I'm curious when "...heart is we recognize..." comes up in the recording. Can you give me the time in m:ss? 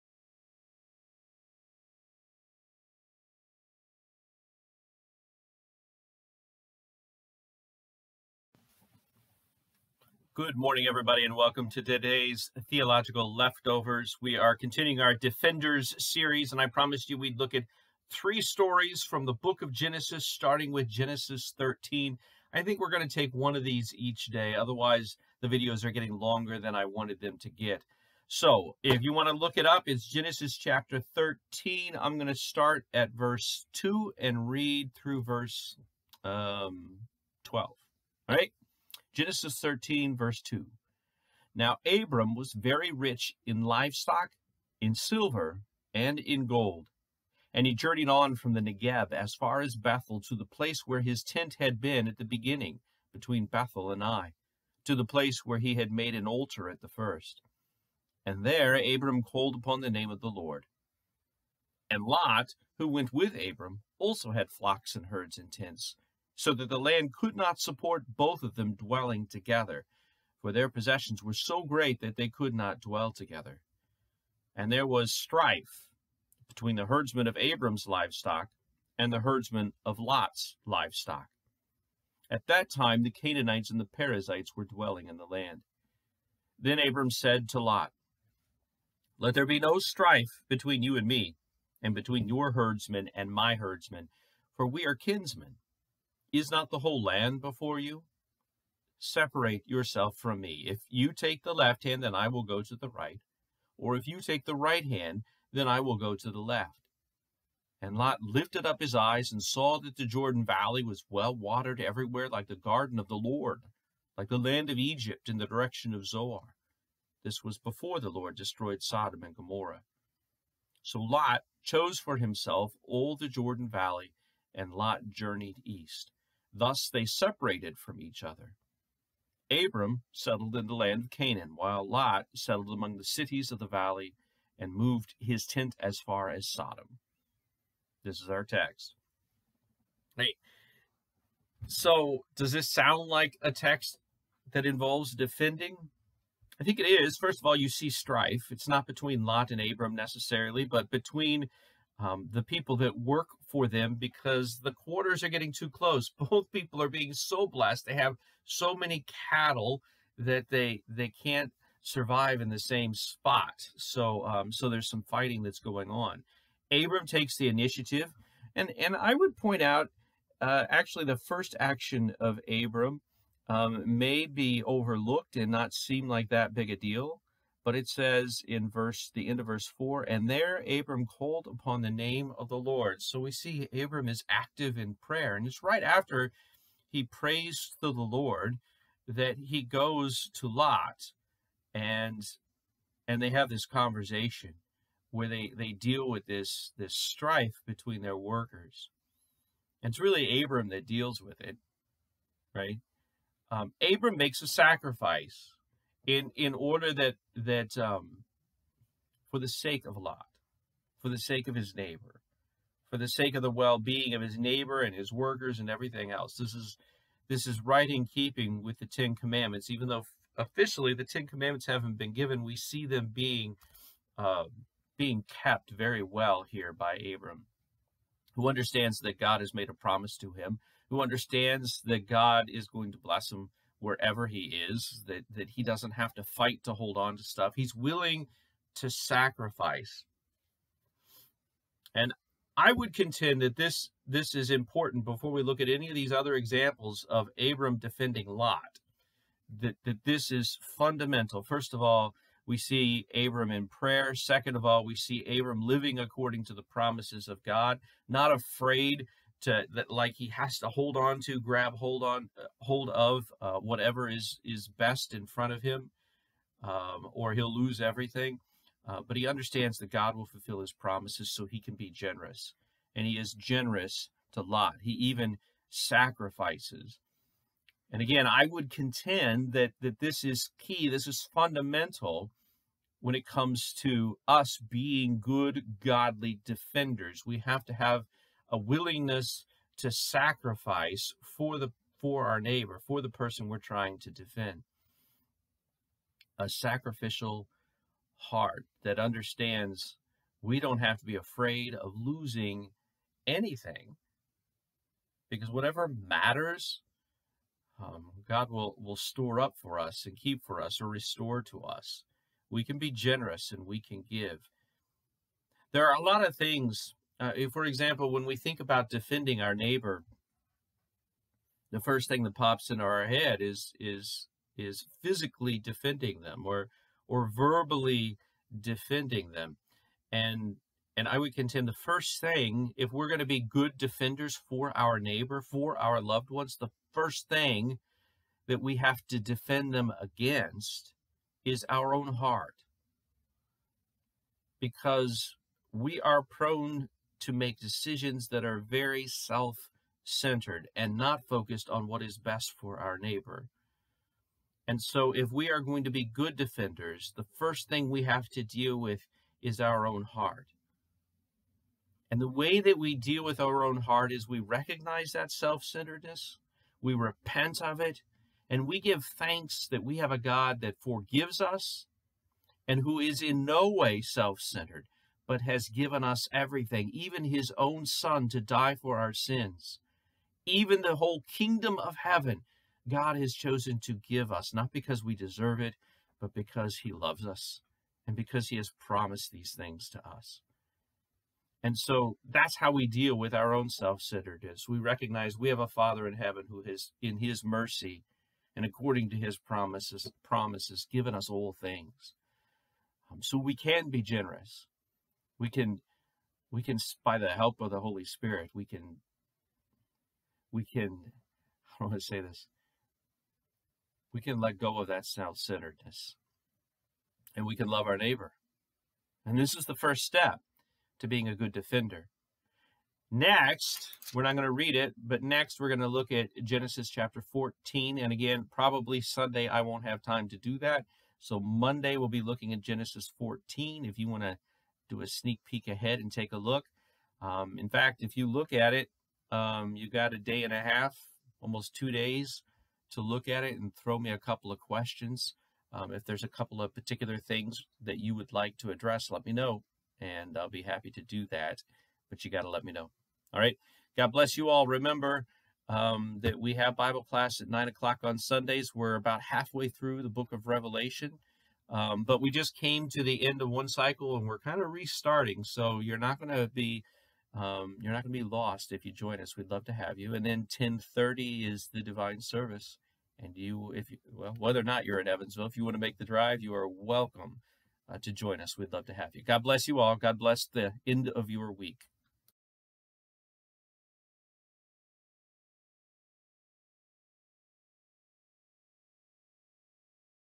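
6:03.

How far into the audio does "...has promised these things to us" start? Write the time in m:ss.
6:28.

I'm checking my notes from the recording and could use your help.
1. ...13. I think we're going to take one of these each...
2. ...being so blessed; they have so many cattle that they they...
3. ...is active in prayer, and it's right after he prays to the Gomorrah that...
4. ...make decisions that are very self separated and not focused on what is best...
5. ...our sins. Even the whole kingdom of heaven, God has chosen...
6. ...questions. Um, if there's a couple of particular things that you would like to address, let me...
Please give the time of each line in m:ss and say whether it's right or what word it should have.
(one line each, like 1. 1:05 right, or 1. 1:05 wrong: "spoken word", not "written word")
1. 0:21 right
2. 2:36 right
3. 3:04 wrong: "Lord", not "Gomorrah"
4. 5:47 wrong: "centered", not "separated"
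5. 6:18 right
6. 7:24 right.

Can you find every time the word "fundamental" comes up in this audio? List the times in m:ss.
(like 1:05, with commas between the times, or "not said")
4:10, 4:41.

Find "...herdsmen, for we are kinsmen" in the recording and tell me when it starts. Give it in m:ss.
1:33.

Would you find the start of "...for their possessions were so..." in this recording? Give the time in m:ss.
1:10.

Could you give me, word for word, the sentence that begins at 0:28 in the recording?
So, if you want to look it up, it's Genesis chapter 13.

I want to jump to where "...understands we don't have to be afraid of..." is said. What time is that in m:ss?
4:58.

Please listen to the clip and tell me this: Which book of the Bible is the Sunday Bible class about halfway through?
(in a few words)
Revelation.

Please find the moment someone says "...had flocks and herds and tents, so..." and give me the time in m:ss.
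1:04.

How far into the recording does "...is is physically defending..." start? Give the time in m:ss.
5:23.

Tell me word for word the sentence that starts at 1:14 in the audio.
And there was strife between the herdsmen of Abram's livestock and the herdsmen of Lot's livestock.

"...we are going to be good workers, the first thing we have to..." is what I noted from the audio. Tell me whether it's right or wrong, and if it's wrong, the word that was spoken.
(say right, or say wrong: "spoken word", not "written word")
wrong: "defenders", not "workers".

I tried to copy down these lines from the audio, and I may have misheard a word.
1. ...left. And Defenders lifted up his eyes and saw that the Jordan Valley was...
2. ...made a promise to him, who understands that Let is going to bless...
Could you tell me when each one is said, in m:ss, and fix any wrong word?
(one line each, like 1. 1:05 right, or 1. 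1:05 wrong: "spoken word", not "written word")
1. 1:46 wrong: "Lot", not "Defenders"
2. 3:49 wrong: "God", not "Let".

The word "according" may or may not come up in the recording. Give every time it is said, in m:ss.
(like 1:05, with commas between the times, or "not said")
4:15, 6:38.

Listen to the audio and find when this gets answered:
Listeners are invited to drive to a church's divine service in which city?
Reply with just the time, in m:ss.
7:55.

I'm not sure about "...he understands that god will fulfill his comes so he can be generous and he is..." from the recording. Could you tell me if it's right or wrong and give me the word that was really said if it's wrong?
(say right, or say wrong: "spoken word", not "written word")
wrong: "promises", not "comes".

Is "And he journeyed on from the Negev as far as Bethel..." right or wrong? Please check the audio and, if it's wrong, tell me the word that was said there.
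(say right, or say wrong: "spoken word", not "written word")
right.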